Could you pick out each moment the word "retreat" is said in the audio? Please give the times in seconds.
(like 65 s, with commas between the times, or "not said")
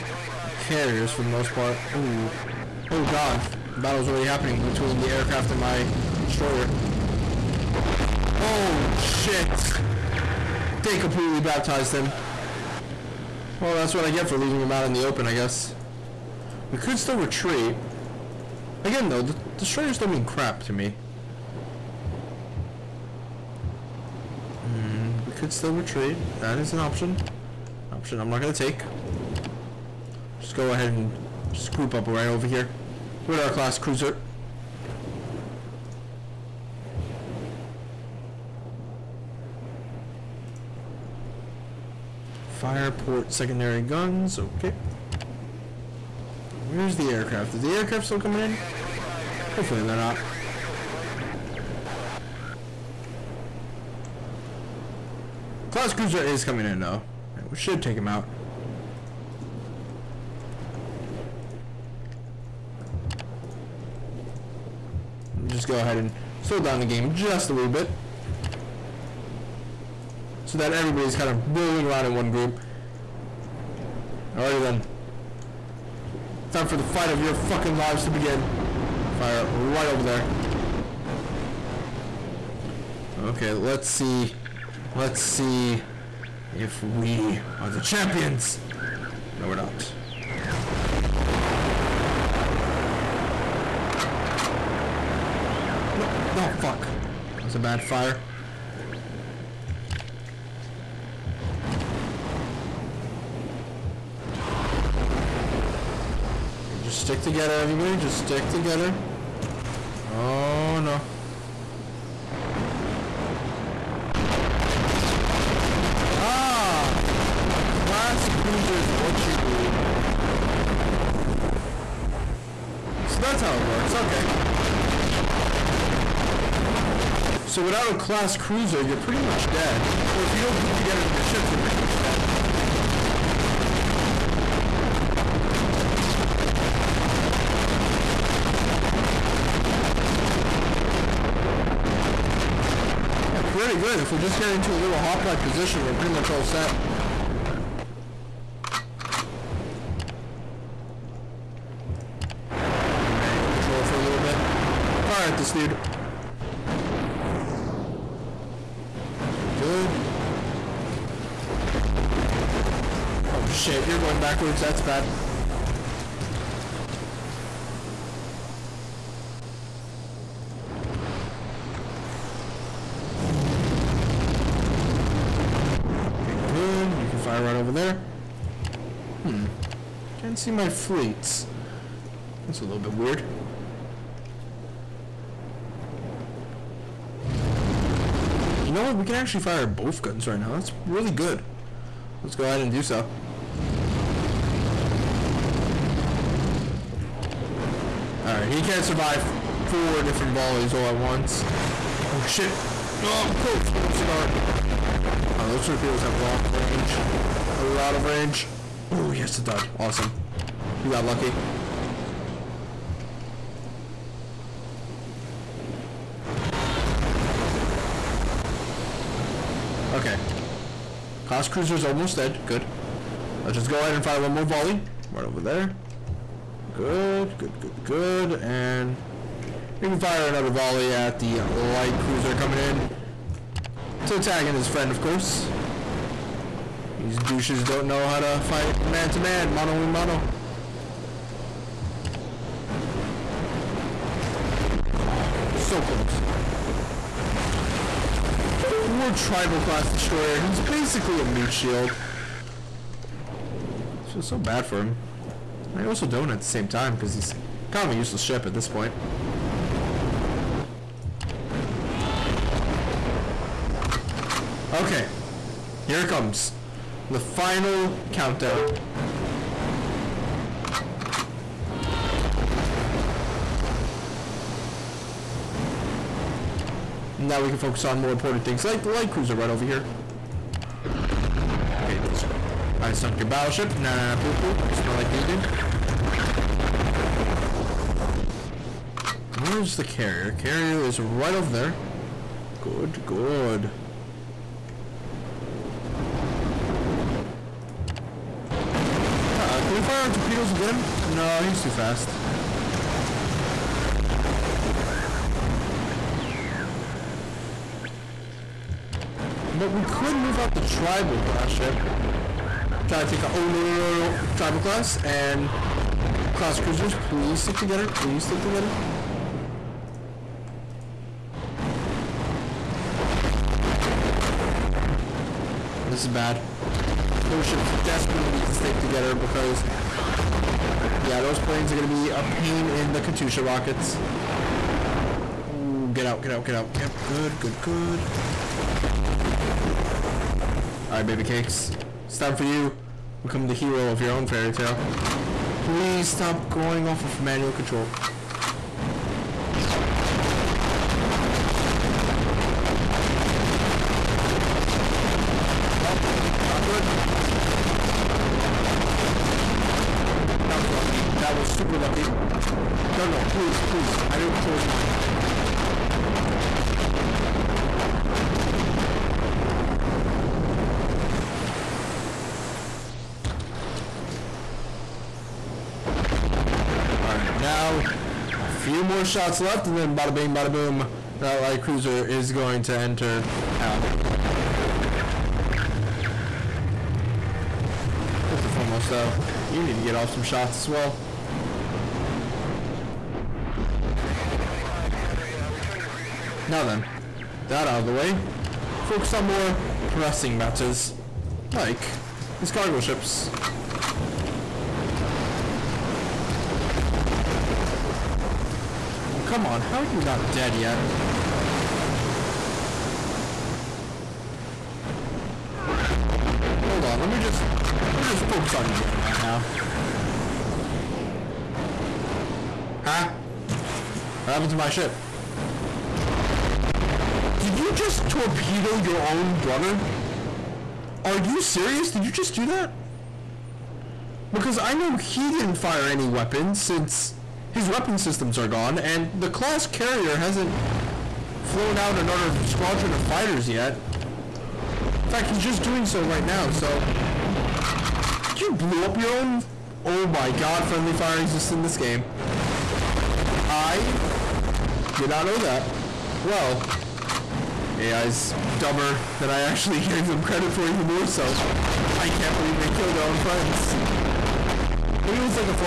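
17 s, 25 s.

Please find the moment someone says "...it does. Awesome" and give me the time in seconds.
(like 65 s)
209 s.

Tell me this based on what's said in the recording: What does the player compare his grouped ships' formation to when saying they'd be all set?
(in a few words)
hoplite position.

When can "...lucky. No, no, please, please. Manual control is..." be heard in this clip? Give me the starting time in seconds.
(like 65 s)
361 s.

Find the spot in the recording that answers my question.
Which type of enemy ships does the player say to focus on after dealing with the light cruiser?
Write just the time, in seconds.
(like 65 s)
402 s.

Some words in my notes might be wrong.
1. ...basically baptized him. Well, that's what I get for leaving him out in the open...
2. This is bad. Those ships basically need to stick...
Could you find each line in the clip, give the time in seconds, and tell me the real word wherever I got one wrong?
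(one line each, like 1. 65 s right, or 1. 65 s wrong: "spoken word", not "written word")
1. 10 s wrong: "completely", not "basically"
2. 325 s wrong: "desperately", not "basically".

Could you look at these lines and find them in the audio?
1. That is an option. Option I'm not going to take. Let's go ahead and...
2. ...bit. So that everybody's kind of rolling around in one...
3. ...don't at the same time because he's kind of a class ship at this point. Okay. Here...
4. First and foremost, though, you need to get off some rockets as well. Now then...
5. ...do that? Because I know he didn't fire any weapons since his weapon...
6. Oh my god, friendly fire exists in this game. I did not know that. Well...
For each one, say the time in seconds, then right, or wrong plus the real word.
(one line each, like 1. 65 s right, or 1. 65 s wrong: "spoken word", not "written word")
1. 26 s right
2. 67 s right
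3. 256 s wrong: "useless", not "class"
4. 388 s wrong: "shots", not "rockets"
5. 432 s right
6. 449 s right.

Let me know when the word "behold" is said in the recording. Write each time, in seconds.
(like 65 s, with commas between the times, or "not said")
not said.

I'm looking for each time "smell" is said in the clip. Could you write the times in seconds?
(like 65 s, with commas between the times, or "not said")
284 s.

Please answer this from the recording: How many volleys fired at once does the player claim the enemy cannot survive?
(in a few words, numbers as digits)
4.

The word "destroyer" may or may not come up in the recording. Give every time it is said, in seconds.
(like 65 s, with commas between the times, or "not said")
6 s, 19 s, 249 s.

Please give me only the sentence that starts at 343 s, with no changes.
Become the hero of your own fairy tale.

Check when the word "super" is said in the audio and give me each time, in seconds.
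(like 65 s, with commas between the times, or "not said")
361 s.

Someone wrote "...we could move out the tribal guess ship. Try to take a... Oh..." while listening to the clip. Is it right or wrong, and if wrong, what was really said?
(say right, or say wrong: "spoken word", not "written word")
wrong: "class", not "guess".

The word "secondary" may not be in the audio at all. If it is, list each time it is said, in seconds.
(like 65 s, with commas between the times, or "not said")
43 s.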